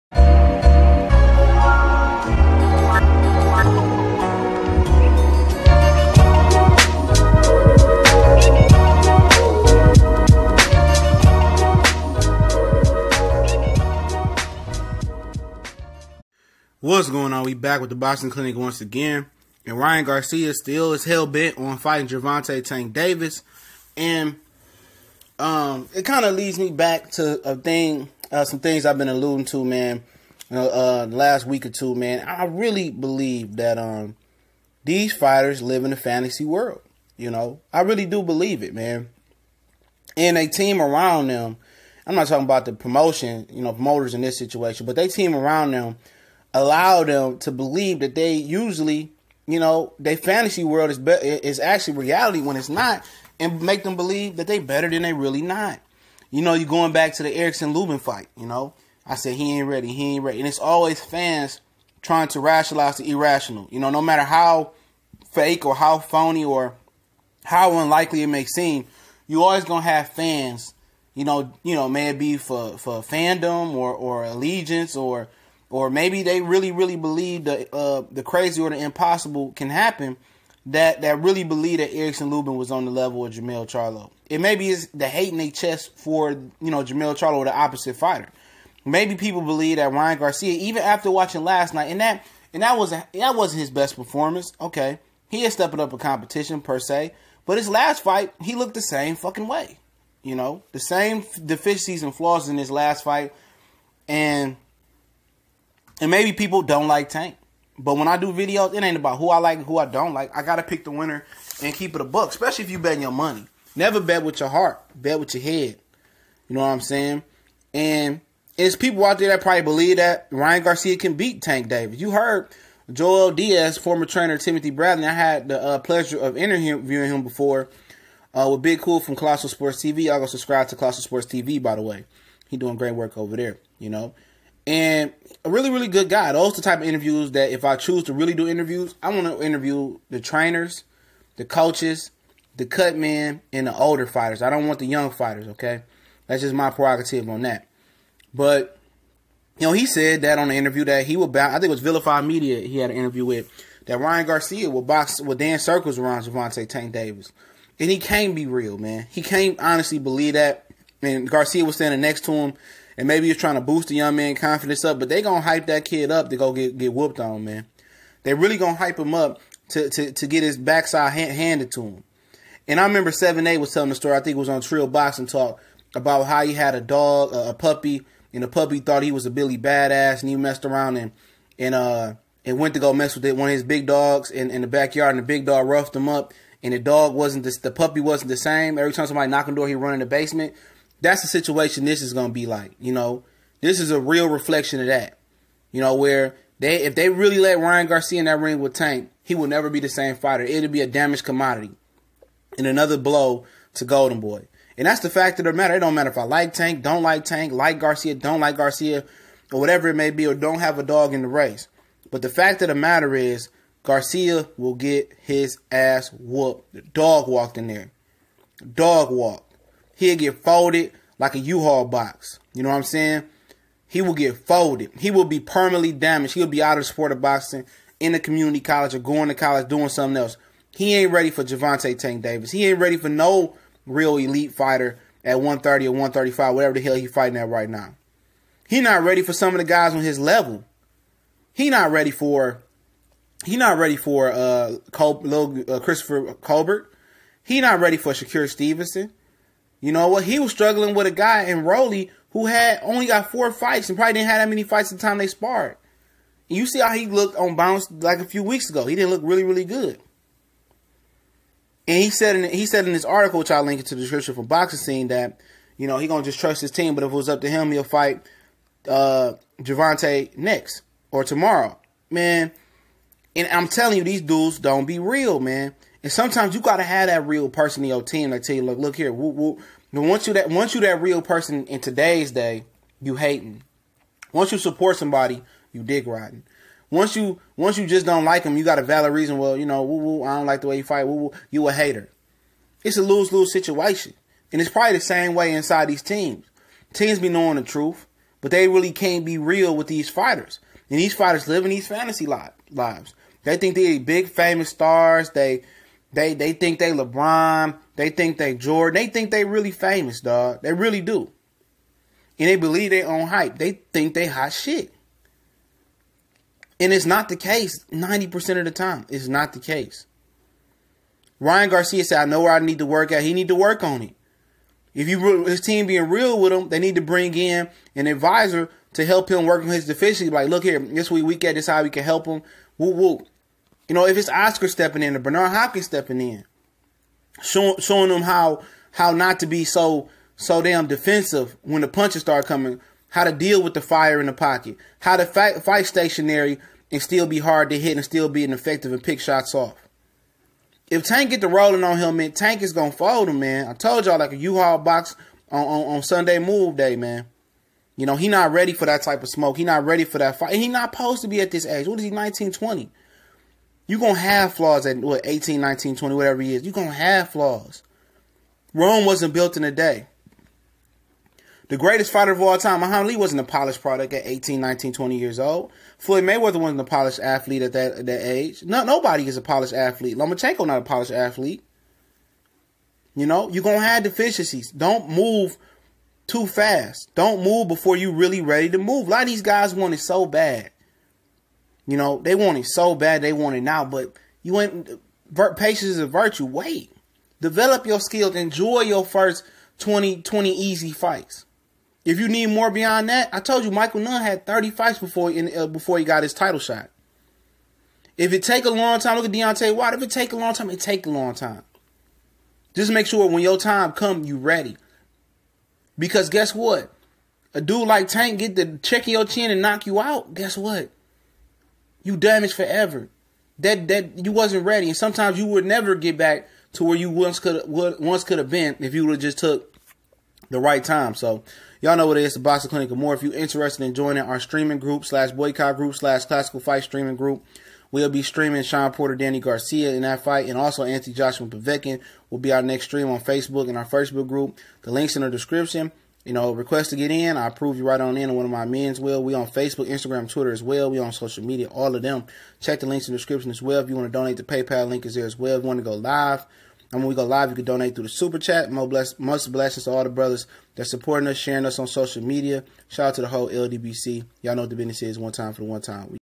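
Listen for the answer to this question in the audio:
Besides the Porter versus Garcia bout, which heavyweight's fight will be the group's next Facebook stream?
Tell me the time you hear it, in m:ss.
7:20.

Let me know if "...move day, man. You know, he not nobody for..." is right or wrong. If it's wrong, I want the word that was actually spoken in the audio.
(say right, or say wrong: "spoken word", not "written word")
wrong: "ready", not "nobody".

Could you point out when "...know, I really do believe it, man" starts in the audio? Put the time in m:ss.
0:37.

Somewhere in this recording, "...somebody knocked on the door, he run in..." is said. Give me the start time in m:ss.
3:09.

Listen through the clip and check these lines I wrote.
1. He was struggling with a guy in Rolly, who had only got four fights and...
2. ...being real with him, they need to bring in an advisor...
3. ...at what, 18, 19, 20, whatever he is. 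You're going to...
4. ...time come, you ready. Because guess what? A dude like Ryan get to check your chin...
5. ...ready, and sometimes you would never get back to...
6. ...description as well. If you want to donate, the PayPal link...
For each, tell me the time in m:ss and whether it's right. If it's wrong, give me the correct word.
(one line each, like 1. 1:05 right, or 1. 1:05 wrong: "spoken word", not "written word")
1. 4:10 right
2. 5:25 right
3. 6:04 right
4. 6:53 wrong: "Tank", not "Ryan"
5. 7:04 right
6. 7:33 right.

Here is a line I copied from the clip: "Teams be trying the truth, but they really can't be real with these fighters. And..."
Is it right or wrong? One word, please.
wrong.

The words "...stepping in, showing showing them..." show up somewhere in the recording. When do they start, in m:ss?
5:35.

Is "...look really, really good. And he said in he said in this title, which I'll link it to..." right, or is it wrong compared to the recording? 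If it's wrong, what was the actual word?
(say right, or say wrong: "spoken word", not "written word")
wrong: "article", not "title".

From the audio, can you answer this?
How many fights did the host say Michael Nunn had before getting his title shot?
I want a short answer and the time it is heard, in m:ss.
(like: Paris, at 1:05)
30, at 6:44.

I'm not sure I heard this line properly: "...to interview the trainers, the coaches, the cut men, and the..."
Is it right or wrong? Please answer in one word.
right.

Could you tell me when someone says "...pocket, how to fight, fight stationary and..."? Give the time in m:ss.
5:44.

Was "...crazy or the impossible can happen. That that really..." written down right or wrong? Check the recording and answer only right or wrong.
right.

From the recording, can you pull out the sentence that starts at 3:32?
But the fact of the matter is, Garcia will get his ass whooped.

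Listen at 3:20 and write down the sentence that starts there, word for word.
It'll be a damaged commodity and another blow to Golden Boy.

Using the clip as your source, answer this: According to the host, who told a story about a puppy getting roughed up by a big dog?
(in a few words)
7A.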